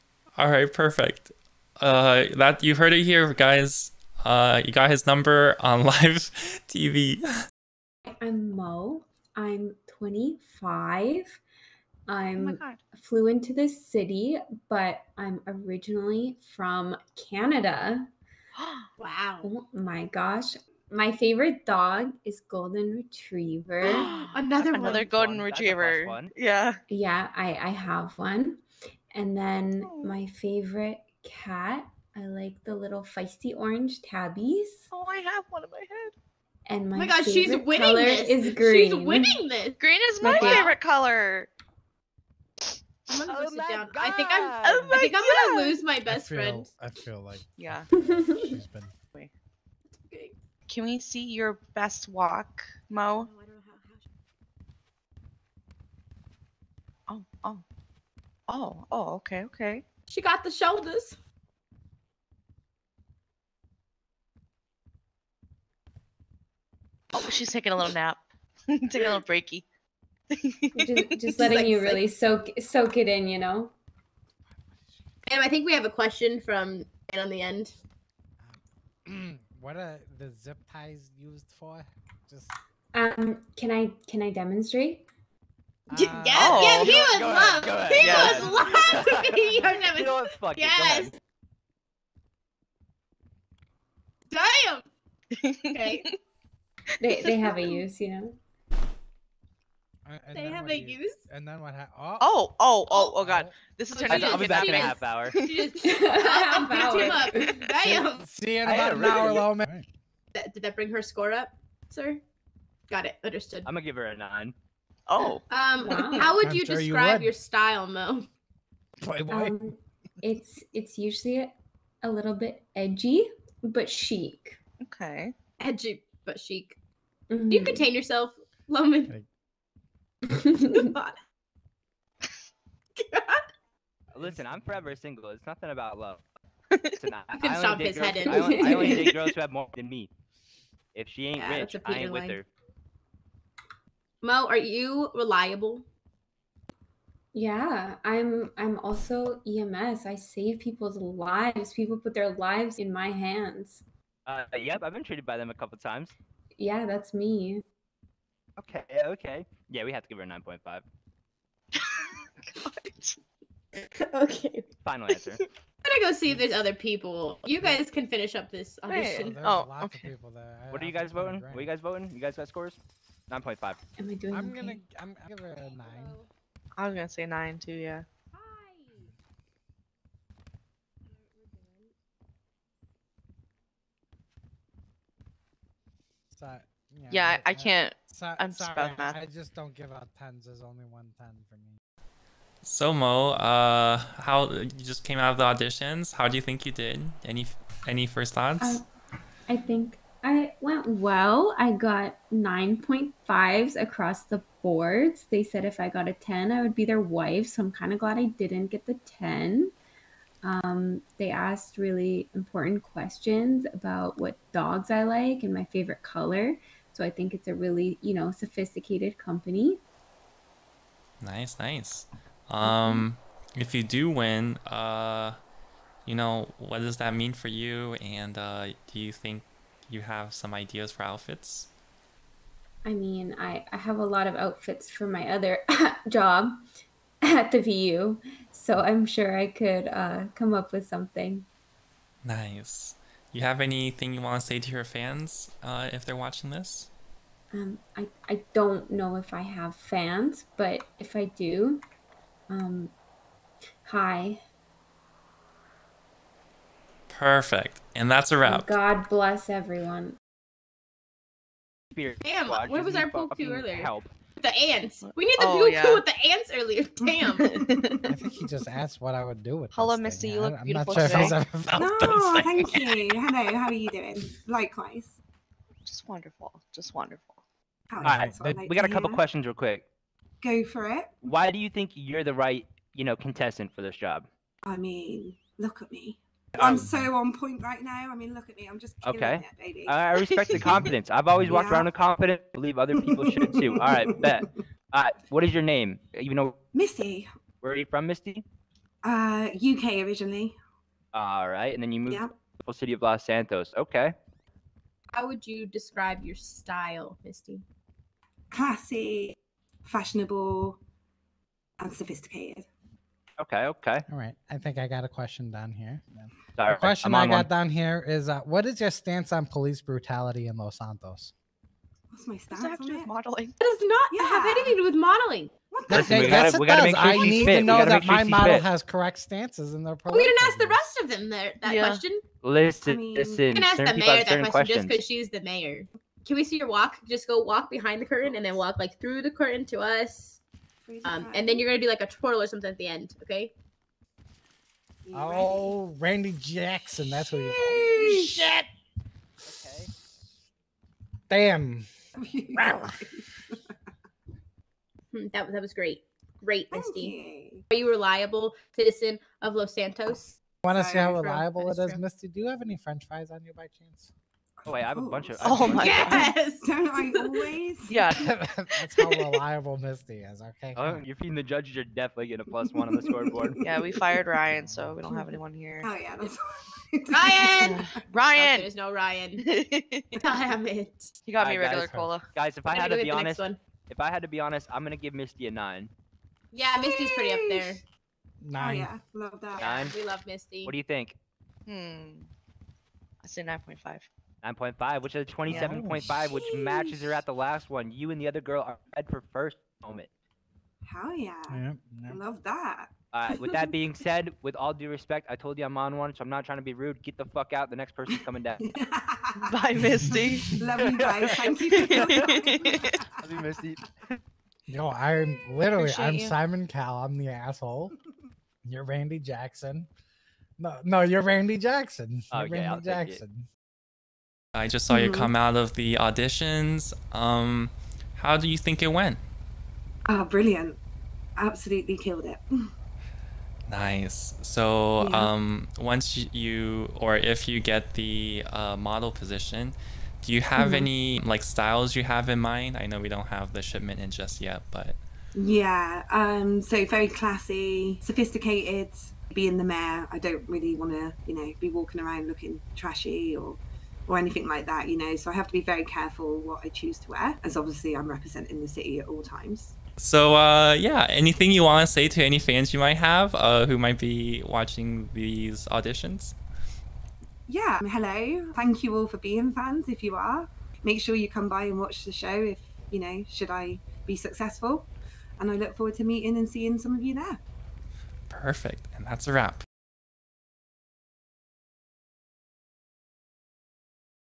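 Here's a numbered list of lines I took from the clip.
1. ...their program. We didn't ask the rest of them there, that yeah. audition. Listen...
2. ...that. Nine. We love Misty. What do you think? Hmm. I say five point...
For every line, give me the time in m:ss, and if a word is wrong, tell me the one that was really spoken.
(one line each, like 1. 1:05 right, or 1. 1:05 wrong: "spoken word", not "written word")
1. 5:29 wrong: "question", not "audition"
2. 6:29 wrong: "nine", not "five".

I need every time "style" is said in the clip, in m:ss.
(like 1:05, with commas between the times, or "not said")
1:57, 5:06, 7:21.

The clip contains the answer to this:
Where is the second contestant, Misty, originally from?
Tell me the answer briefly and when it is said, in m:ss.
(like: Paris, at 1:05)
UK, at 4:59.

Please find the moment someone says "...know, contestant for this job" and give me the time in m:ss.
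4:43.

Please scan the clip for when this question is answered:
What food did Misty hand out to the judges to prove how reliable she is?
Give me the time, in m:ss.
6:02.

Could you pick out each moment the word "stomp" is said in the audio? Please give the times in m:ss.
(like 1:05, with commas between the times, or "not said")
2:17.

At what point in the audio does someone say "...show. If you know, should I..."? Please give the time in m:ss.
7:52.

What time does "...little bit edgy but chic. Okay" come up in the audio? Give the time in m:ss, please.
2:02.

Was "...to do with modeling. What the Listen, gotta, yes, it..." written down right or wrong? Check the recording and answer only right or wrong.
right.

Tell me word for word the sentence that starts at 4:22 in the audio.
Damn, what was our poo earlier?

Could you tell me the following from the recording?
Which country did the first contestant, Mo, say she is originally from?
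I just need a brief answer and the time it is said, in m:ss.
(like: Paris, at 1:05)
Canada, at 0:17.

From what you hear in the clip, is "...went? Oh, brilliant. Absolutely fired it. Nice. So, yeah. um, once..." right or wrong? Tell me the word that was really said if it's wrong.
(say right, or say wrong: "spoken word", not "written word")
wrong: "killed", not "fired".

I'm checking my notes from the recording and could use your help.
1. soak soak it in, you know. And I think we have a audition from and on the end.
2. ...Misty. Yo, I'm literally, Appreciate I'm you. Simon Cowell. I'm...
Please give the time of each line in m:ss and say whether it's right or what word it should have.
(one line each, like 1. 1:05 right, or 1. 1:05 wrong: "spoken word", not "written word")
1. 1:12 wrong: "question", not "audition"
2. 6:53 right.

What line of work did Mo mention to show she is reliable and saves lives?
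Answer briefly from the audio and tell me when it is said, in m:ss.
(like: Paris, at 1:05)
EMS, at 2:29.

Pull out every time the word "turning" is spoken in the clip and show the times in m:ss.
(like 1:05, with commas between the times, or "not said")
1:43.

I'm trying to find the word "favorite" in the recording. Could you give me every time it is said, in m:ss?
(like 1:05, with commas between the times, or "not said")
0:21, 0:30, 0:40, 3:35.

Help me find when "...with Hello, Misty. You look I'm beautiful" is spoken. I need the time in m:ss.
4:29.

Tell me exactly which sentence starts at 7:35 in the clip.
So I have to be very careful what I choose to wear, as obviously I'm representing the city at all times.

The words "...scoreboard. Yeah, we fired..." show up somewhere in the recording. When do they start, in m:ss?
6:13.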